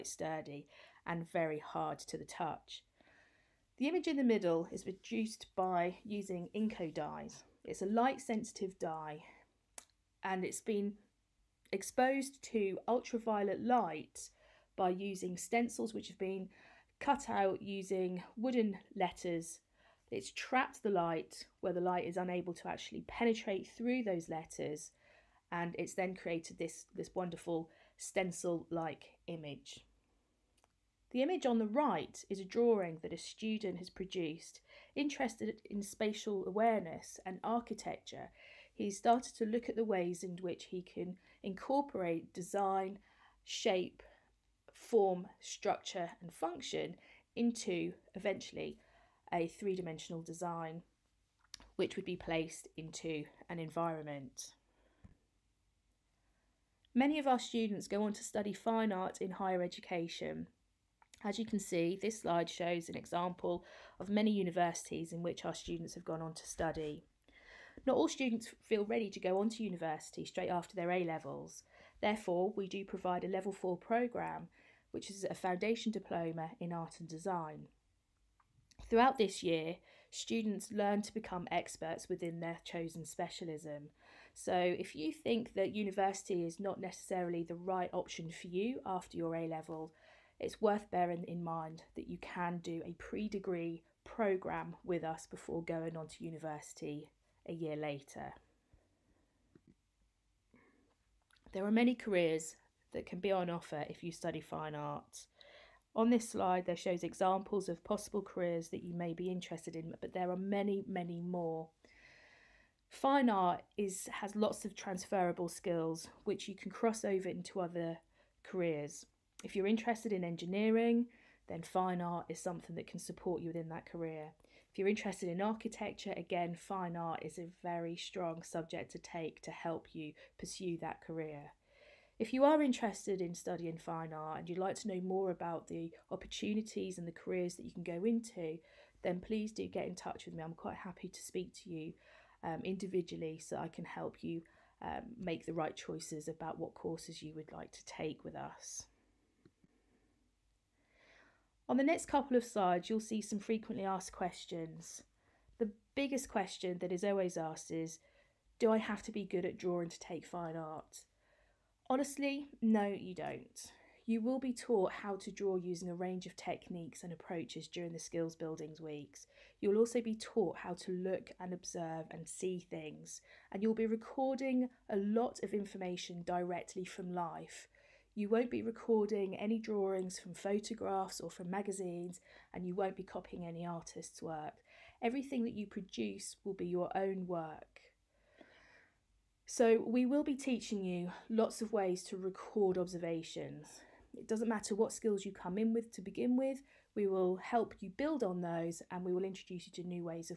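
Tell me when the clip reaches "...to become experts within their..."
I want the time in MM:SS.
01:21.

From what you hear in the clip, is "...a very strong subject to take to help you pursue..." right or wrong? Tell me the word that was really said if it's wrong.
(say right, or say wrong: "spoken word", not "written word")
right.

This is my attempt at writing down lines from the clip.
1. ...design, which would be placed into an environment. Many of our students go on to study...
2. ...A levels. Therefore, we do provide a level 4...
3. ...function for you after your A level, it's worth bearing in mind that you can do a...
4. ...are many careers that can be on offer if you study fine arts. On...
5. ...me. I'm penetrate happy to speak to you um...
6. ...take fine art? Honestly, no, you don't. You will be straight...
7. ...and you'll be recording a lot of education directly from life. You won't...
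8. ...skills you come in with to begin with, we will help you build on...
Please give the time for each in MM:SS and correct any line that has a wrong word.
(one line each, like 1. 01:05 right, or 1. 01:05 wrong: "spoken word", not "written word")
1. 00:50 right
2. 01:10 right
3. 01:27 wrong: "option", not "function"
4. 01:41 right
5. 02:20 wrong: "quite", not "penetrate"
6. 02:39 wrong: "taught", not "straight"
7. 02:53 wrong: "information", not "education"
8. 03:14 right.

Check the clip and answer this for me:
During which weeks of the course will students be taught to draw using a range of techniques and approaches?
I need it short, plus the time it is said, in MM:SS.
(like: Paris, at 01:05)
skills building weeks, at 02:47.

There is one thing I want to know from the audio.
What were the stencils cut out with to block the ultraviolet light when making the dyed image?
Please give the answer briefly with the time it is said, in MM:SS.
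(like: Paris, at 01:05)
wooden letters, at 00:18.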